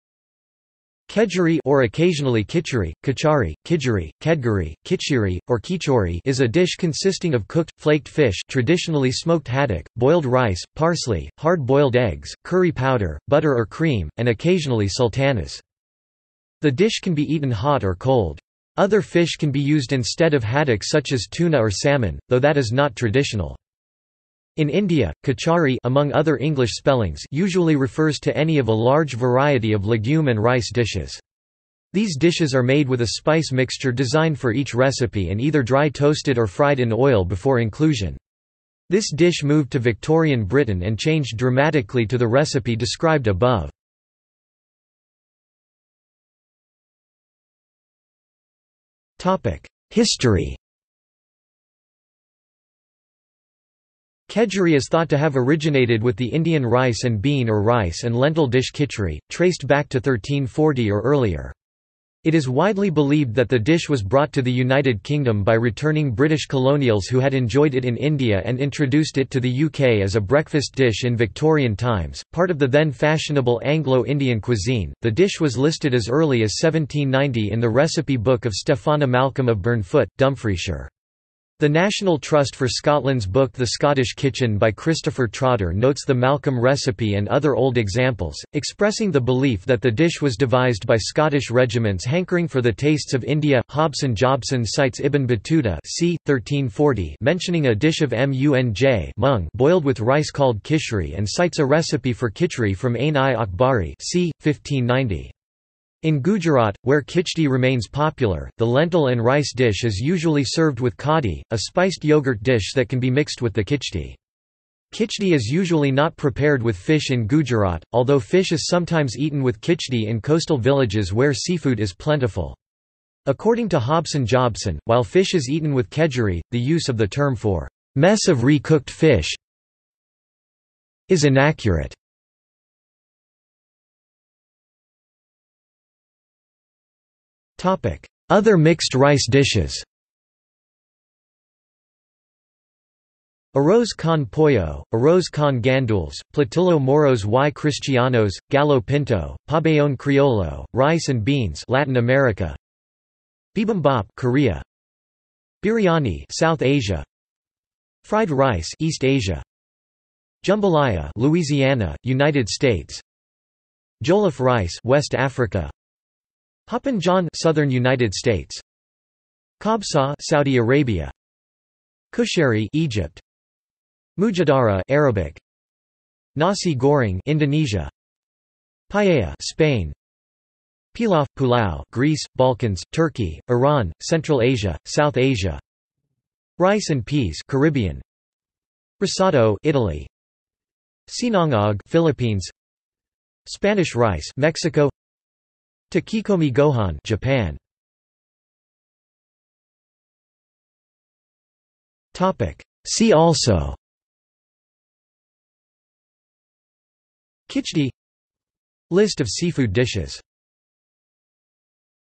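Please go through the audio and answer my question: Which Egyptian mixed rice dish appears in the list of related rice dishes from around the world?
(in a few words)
Kushari.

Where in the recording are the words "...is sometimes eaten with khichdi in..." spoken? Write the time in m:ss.
1:58.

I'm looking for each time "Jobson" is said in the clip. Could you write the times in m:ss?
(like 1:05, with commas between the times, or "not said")
1:34, 2:04.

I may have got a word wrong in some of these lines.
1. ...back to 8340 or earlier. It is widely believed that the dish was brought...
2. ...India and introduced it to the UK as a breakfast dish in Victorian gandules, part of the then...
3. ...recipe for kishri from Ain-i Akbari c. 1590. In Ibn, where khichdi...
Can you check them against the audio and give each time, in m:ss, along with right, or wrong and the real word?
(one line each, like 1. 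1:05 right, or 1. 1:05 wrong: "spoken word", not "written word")
1. 0:59 wrong: "1340", not "8340"
2. 1:07 wrong: "times", not "gandules"
3. 1:41 wrong: "Gujarat", not "Ibn".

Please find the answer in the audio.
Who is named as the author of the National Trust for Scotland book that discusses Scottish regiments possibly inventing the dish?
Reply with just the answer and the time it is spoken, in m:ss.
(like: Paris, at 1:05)
Christopher Trotter, at 1:24.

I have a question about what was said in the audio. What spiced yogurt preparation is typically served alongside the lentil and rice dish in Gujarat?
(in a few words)
kadi.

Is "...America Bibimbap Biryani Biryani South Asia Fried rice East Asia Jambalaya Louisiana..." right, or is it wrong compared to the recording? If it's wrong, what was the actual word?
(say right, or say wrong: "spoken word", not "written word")
wrong: "Korea", not "Biryani".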